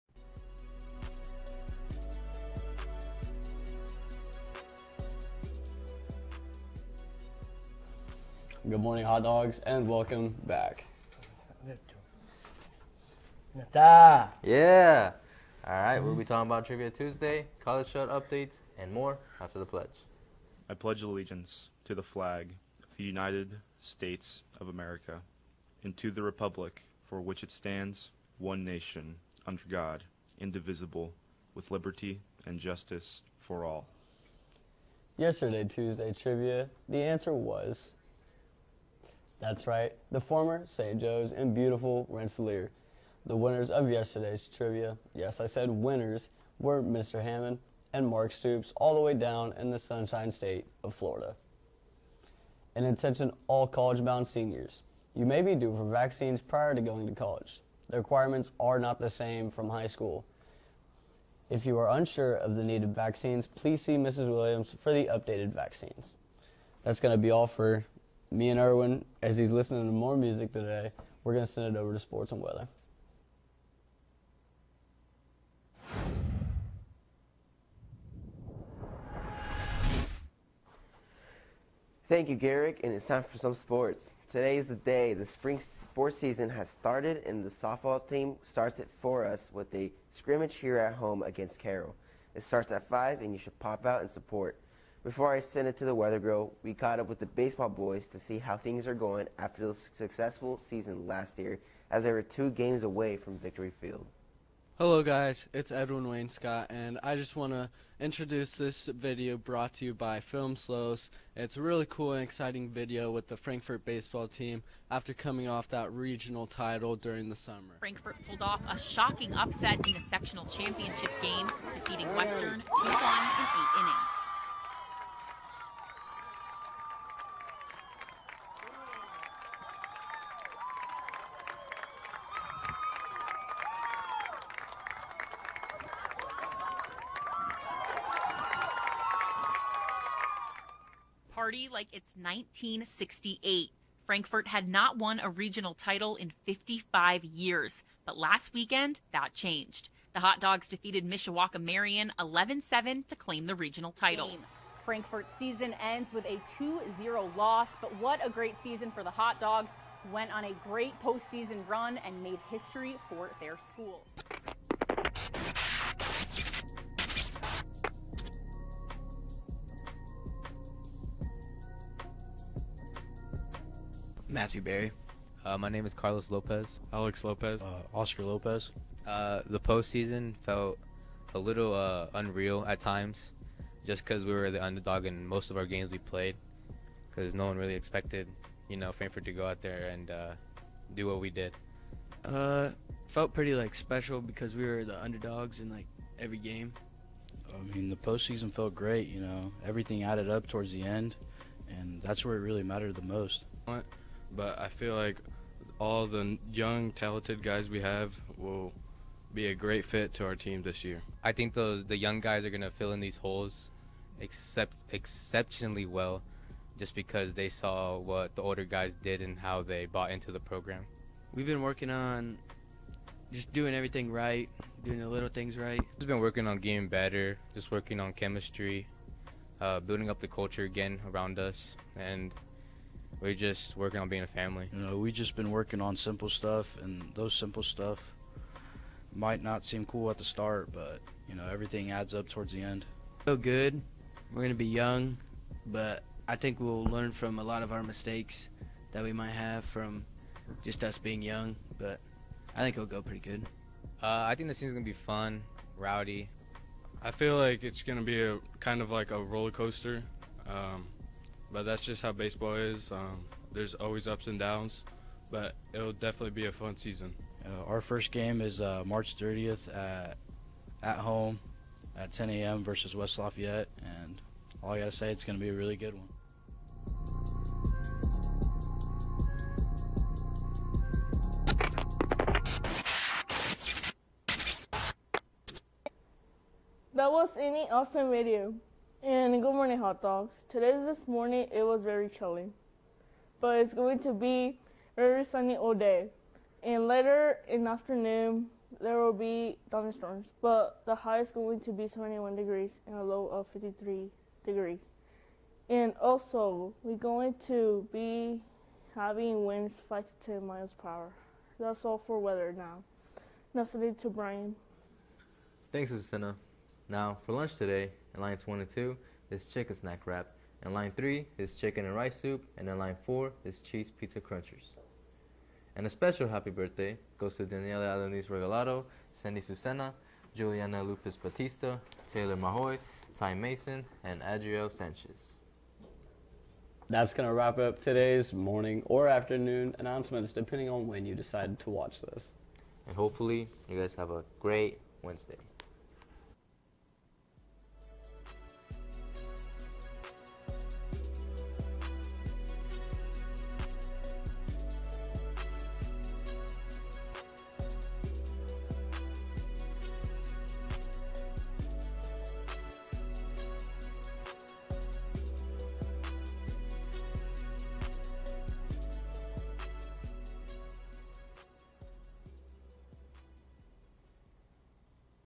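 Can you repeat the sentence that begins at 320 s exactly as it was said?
In line 3 is chicken and rice soup.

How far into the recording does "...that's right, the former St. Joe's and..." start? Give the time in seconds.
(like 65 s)
39 s.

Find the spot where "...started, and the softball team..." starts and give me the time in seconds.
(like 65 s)
86 s.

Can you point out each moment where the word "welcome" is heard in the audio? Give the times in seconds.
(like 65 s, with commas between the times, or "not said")
9 s.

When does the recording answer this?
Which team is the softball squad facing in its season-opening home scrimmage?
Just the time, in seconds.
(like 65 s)
91 s.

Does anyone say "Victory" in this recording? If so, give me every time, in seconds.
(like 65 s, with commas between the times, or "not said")
103 s.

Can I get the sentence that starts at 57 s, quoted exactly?
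The requirements are not the same from high school.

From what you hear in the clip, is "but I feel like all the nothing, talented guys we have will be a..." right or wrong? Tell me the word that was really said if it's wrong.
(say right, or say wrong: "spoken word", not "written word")
wrong: "young", not "nothing".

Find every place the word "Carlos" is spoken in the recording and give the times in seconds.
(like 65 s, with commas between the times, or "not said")
175 s.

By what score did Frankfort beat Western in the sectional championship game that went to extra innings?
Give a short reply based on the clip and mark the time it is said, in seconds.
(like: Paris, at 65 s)
2-1, at 122 s.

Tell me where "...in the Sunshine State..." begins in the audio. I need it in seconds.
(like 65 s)
49 s.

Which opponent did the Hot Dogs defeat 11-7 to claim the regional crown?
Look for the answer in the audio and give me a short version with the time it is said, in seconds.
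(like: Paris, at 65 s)
Mishawaka Marian, at 151 s.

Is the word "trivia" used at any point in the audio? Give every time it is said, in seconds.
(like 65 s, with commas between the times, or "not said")
16 s, 36 s, 44 s.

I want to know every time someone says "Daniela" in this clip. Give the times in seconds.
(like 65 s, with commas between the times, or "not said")
327 s.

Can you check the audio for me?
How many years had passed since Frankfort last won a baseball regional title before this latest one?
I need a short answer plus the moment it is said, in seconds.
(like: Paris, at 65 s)
55, at 146 s.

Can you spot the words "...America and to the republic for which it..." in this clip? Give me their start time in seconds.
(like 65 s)
24 s.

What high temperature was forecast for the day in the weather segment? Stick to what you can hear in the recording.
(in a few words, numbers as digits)
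71 degrees.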